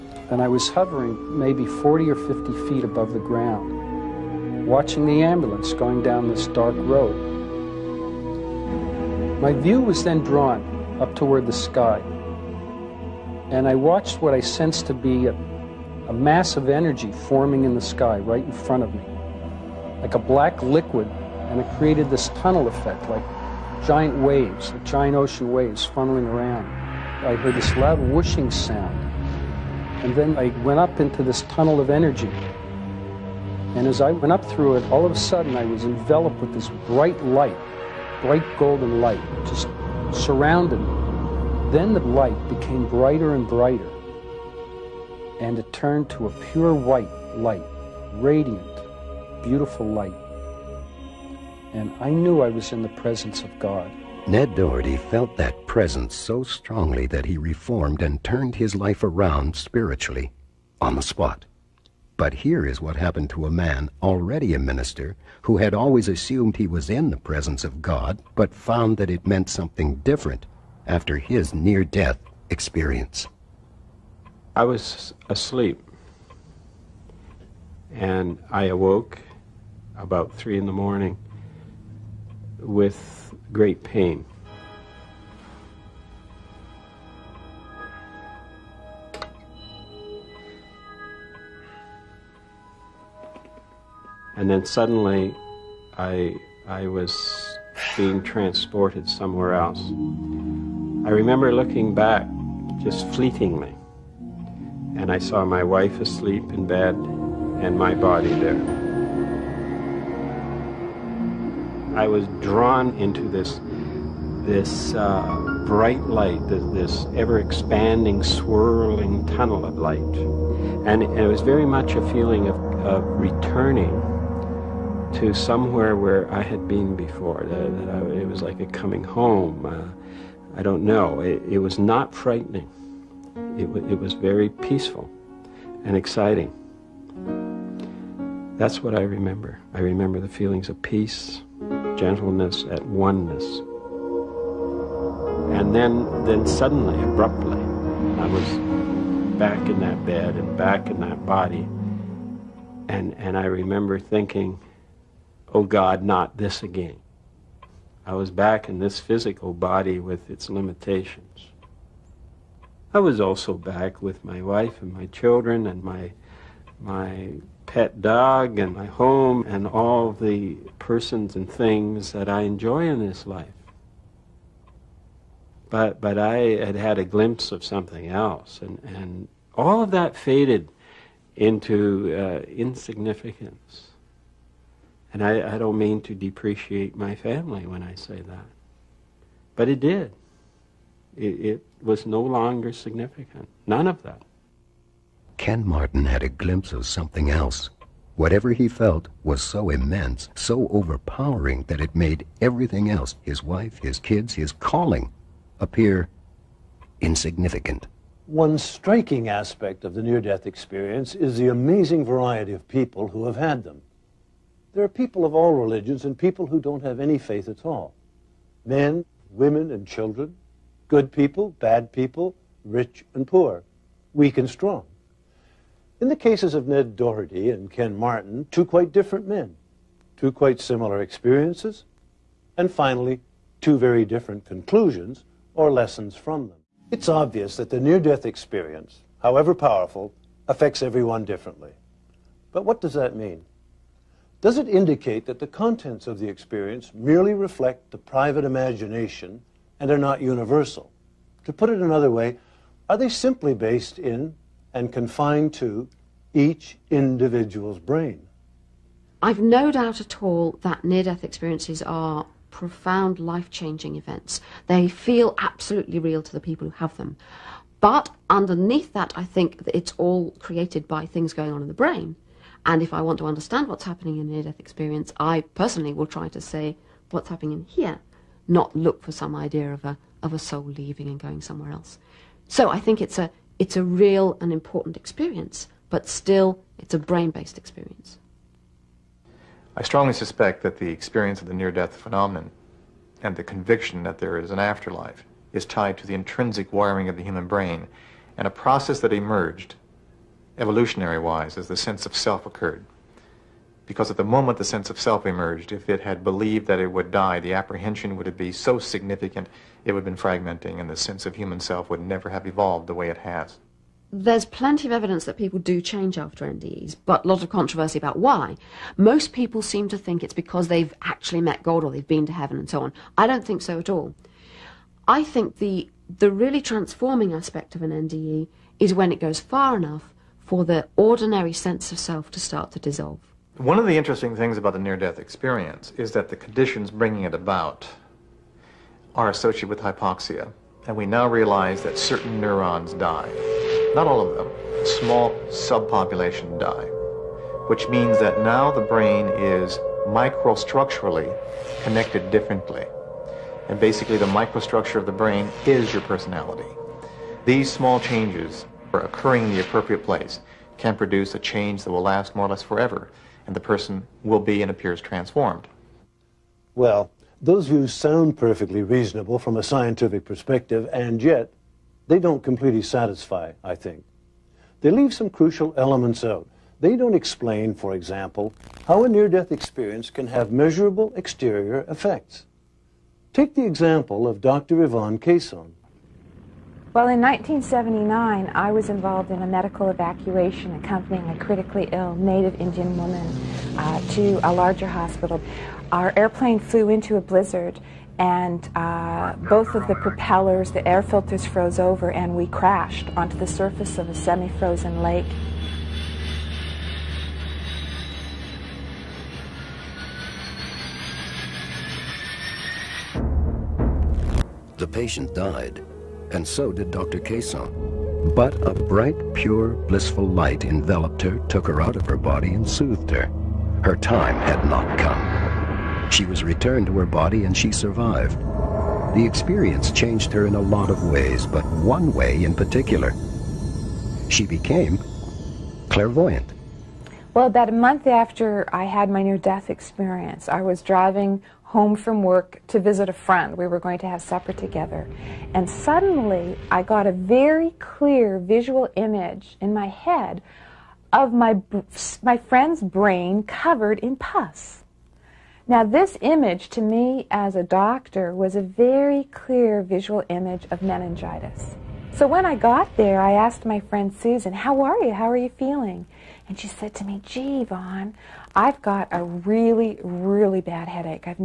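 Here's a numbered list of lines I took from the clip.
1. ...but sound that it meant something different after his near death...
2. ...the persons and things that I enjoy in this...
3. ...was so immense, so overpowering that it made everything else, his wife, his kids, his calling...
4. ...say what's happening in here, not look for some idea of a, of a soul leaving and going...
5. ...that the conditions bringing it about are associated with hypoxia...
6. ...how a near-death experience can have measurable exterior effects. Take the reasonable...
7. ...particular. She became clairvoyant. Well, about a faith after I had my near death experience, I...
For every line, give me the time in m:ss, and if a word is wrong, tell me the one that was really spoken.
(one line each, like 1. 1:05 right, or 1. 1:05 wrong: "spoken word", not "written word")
1. 1:08 wrong: "found", not "sound"
2. 2:50 right
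3. 3:19 right
4. 4:36 right
5. 5:36 right
6. 6:18 wrong: "example", not "reasonable"
7. 7:12 wrong: "month", not "faith".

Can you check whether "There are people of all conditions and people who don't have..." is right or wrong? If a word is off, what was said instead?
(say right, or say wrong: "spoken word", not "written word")
wrong: "religions", not "conditions".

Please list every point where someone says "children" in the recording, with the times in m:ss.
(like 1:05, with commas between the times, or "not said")
2:45, 3:39.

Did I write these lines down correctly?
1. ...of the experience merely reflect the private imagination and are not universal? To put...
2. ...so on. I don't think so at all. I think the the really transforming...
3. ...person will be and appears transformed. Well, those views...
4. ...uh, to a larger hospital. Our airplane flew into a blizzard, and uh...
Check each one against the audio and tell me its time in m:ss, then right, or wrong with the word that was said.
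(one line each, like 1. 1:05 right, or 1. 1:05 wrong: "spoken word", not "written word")
1. 4:06 right
2. 5:22 right
3. 6:03 right
4. 6:33 right.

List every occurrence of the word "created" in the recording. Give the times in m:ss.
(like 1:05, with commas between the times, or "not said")
0:21, 4:30.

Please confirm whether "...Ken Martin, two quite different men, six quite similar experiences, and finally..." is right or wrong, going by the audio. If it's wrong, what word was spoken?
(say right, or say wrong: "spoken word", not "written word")
wrong: "two", not "six".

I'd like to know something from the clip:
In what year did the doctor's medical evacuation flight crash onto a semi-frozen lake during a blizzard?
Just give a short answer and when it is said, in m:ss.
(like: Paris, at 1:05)
1979, at 6:27.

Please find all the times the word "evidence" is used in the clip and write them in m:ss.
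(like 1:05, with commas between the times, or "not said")
5:14.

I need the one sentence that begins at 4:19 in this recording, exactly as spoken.
I've no doubt at all that near death experiences are profound life changing events.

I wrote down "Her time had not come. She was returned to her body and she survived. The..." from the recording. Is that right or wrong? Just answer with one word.
right.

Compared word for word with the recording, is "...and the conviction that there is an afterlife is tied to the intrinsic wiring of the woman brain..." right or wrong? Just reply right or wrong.
wrong.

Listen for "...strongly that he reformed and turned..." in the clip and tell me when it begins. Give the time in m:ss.
0:56.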